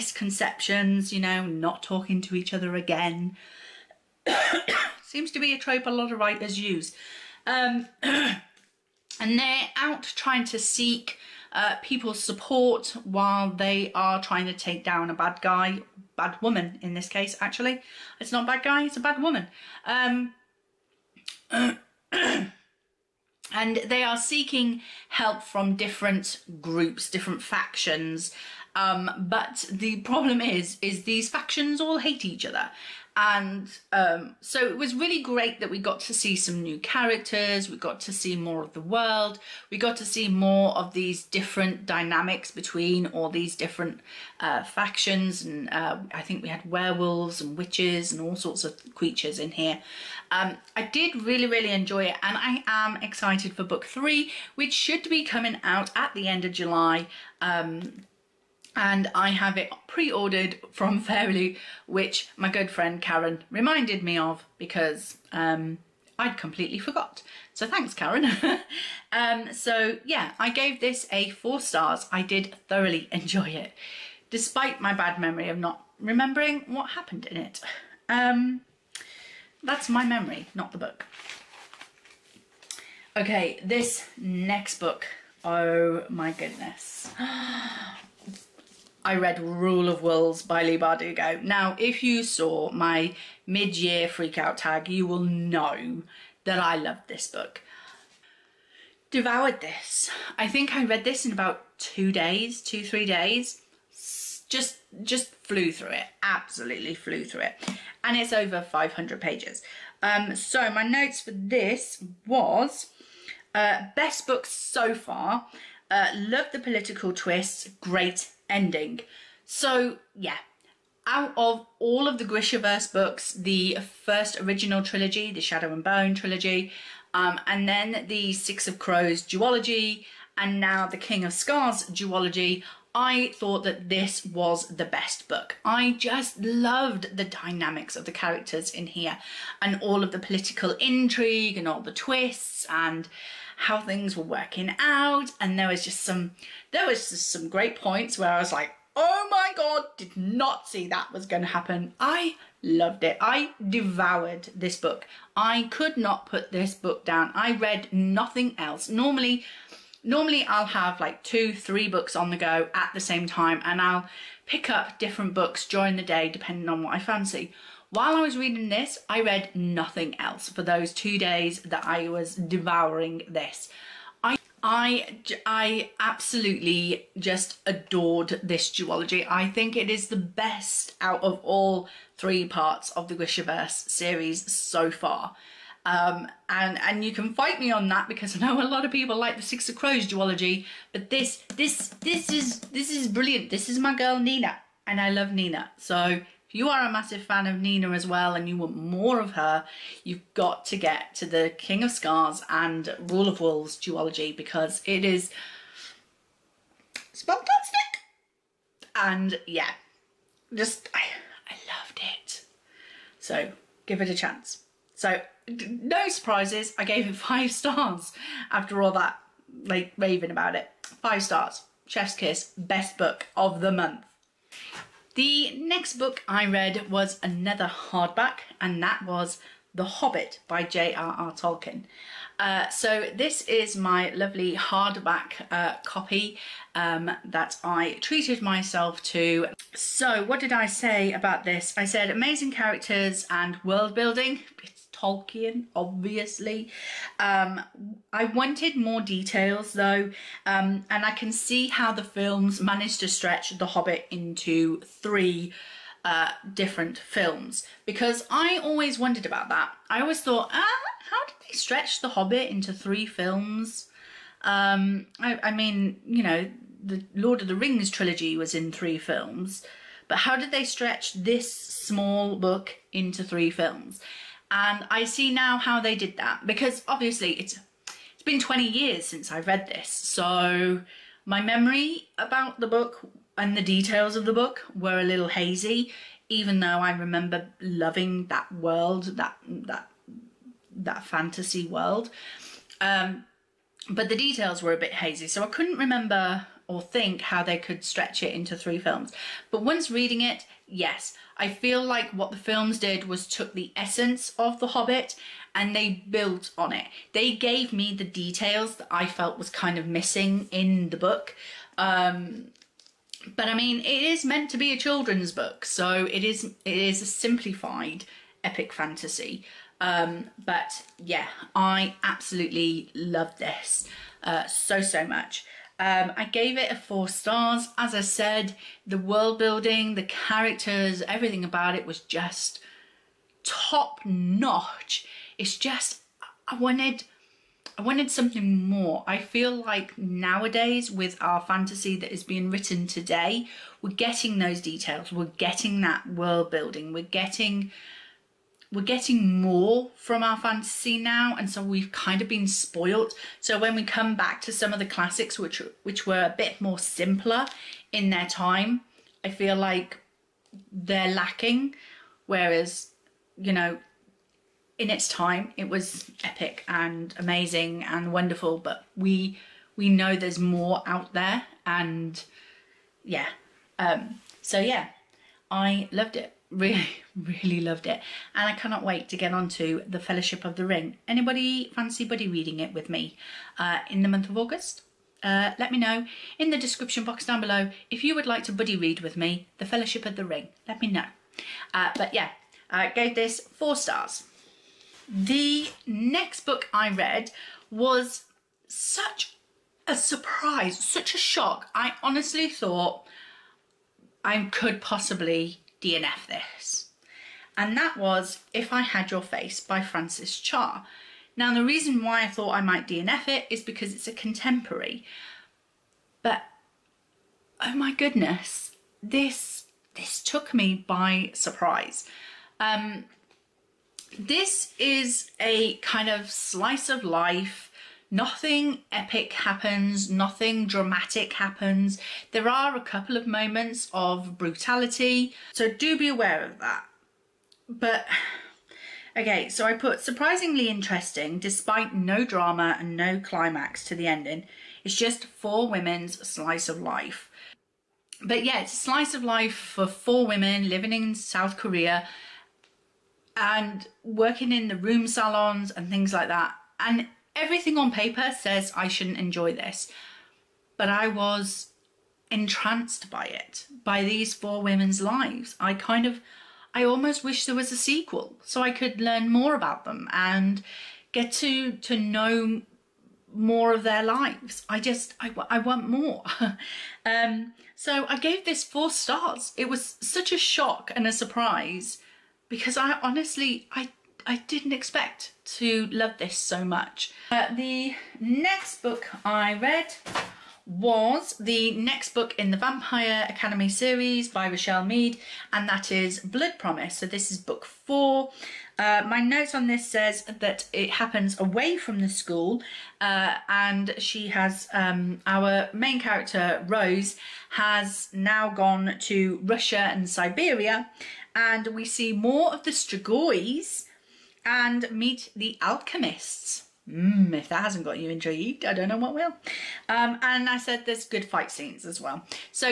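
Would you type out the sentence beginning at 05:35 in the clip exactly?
It's just, I wanted, I wanted something more.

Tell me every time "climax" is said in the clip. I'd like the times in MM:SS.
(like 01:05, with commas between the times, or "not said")
07:23.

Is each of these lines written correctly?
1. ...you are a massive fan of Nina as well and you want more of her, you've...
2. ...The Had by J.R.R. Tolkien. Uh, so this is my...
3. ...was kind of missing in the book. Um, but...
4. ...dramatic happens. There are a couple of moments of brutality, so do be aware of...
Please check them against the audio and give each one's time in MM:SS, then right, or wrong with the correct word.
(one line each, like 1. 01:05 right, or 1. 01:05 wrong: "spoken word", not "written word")
1. 03:16 right
2. 03:49 wrong: "Hobbit", not "Had"
3. 05:09 right
4. 07:10 right.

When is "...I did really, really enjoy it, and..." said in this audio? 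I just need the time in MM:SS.
00:50.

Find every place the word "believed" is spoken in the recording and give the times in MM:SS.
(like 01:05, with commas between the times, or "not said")
not said.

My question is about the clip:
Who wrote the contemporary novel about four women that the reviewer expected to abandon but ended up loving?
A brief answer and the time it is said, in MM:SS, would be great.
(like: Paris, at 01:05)
Frances Cha, at 06:49.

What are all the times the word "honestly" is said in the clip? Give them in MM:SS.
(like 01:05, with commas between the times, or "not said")
06:42, 08:02.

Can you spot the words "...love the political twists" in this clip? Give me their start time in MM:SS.
01:56.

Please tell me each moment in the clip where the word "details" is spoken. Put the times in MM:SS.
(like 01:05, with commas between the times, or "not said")
04:09, 04:43, 04:54, 05:08, 05:44.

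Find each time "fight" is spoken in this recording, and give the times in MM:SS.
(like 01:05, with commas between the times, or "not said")
03:07, 08:41.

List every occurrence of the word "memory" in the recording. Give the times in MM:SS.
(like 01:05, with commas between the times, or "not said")
01:15, 01:20, 04:41.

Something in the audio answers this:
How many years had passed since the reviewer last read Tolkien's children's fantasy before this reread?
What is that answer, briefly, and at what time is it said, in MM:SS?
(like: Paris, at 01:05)
20, at 04:38.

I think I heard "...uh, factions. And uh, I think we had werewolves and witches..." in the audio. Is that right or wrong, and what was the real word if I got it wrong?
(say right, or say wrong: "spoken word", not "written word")
right.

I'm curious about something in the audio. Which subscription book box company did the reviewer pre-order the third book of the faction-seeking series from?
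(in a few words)
FairyLoot.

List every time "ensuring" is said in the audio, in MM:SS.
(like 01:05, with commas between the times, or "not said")
not said.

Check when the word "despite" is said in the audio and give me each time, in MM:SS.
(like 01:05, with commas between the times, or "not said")
01:14, 07:21.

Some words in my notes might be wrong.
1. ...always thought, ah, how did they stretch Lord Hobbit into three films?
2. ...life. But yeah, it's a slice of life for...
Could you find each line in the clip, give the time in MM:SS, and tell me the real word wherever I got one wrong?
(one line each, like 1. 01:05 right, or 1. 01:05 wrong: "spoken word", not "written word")
1. 04:20 wrong: "The", not "Lord"
2. 07:26 right.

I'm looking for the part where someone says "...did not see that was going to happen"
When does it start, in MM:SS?
02:29.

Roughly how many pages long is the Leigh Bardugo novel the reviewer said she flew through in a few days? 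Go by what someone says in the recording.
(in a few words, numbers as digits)
over 500.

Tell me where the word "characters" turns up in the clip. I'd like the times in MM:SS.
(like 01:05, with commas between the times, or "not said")
00:36, 02:18, 04:02, 05:30, 08:25.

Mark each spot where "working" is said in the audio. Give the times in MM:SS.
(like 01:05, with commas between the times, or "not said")
02:24, 07:34.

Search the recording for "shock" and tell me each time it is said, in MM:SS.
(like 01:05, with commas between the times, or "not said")
06:41, 08:00.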